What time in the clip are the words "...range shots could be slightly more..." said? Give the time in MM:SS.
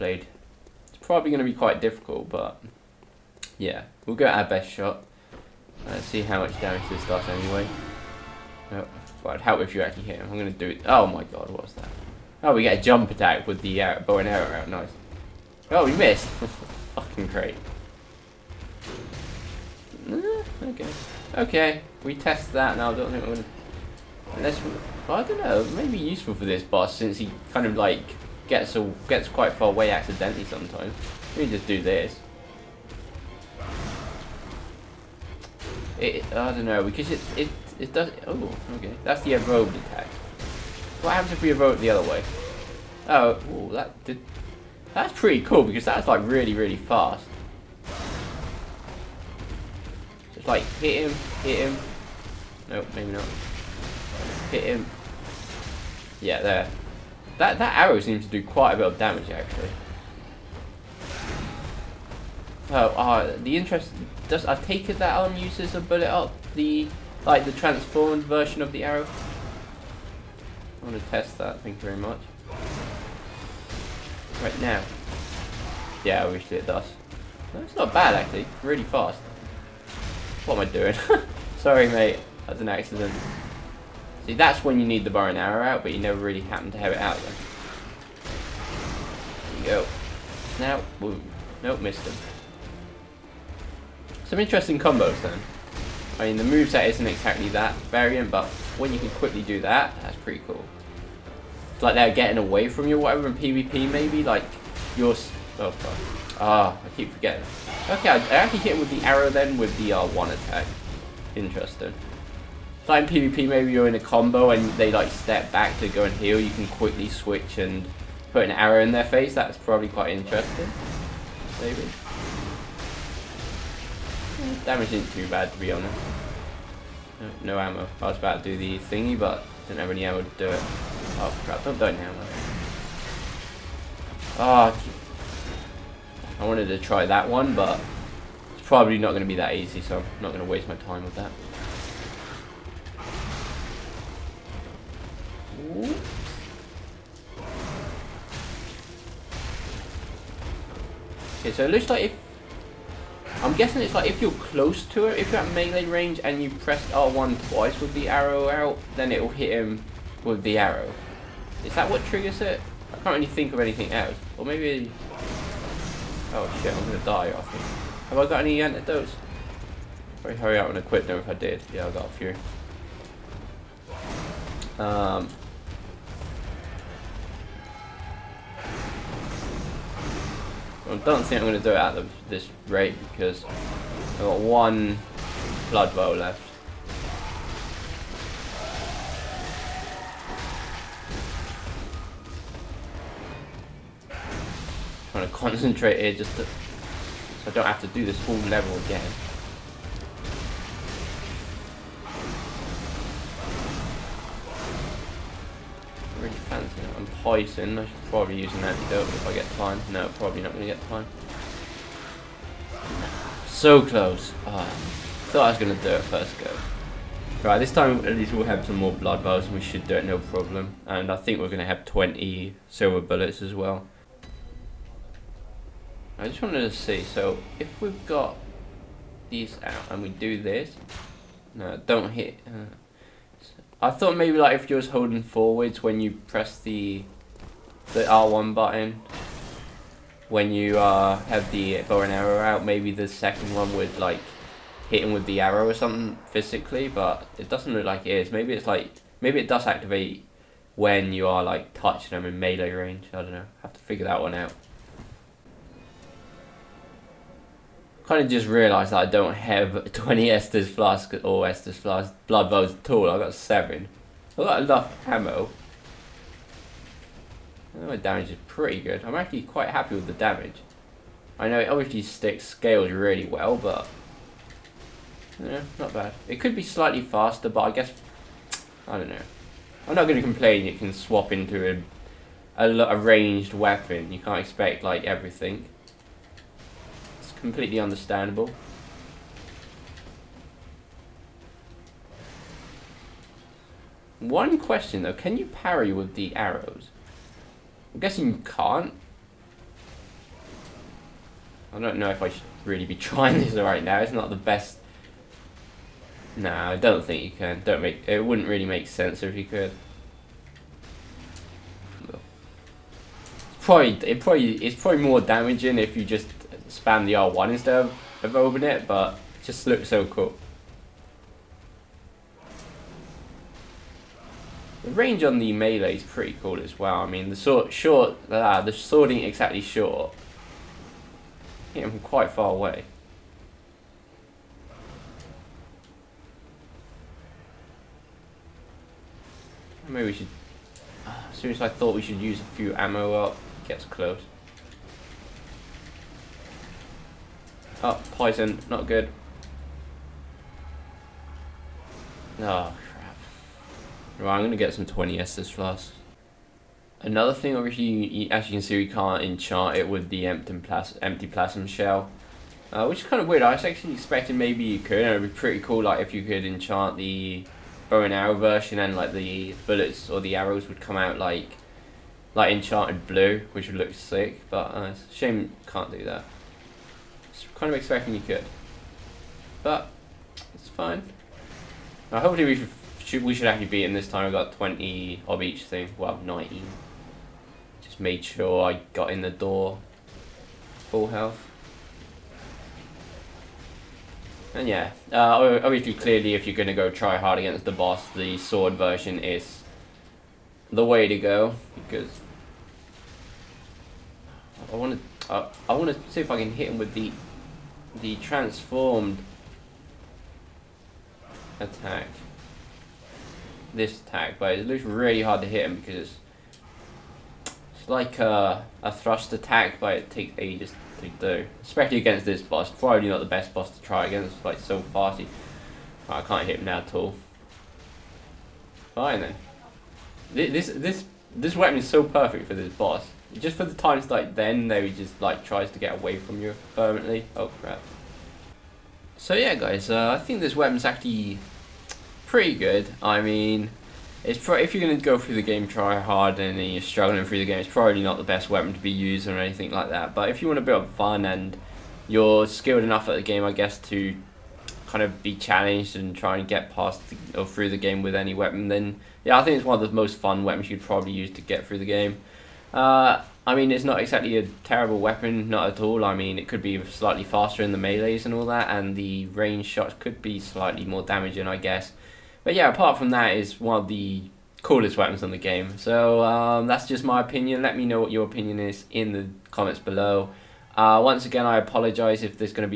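07:49.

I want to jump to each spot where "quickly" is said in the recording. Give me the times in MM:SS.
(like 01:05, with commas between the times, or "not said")
01:39, 01:56.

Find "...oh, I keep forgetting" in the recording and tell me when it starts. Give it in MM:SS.
01:46.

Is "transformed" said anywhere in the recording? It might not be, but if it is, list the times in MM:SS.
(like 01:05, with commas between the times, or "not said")
01:07, 06:48.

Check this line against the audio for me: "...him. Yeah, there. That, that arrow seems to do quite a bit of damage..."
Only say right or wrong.
right.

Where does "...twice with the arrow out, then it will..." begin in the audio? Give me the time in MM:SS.
02:37.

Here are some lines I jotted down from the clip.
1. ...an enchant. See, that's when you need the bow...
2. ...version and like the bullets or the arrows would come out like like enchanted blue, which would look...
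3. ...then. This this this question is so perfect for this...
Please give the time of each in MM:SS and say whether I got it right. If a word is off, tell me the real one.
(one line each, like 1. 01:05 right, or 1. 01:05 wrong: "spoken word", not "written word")
1. 01:22 wrong: "accident", not "enchant"
2. 06:08 right
3. 07:09 wrong: "weapon", not "question".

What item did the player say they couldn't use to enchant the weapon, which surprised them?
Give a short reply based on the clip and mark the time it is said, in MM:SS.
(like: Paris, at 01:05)
empty phantasm shell, at 06:01.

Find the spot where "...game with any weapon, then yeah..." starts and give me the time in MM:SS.
07:37.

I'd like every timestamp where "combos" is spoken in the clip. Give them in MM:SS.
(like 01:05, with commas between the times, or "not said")
01:34, 01:53.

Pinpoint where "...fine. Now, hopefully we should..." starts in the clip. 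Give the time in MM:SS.
06:20.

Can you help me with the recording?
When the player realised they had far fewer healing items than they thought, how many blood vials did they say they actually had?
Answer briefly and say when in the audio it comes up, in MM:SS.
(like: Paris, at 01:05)
7, at 04:23.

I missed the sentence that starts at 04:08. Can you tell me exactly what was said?
Maybe it's like, maybe it does activate when you are like touching them in melee range.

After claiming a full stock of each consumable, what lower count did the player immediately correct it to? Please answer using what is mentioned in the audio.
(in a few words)
19.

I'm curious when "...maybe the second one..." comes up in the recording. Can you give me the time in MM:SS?
04:02.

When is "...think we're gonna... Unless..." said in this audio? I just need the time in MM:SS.
00:23.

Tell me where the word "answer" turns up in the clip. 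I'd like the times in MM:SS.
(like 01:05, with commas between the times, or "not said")
not said.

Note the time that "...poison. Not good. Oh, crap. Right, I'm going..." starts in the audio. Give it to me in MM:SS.
05:48.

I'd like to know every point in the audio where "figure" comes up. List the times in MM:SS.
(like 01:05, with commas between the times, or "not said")
04:13.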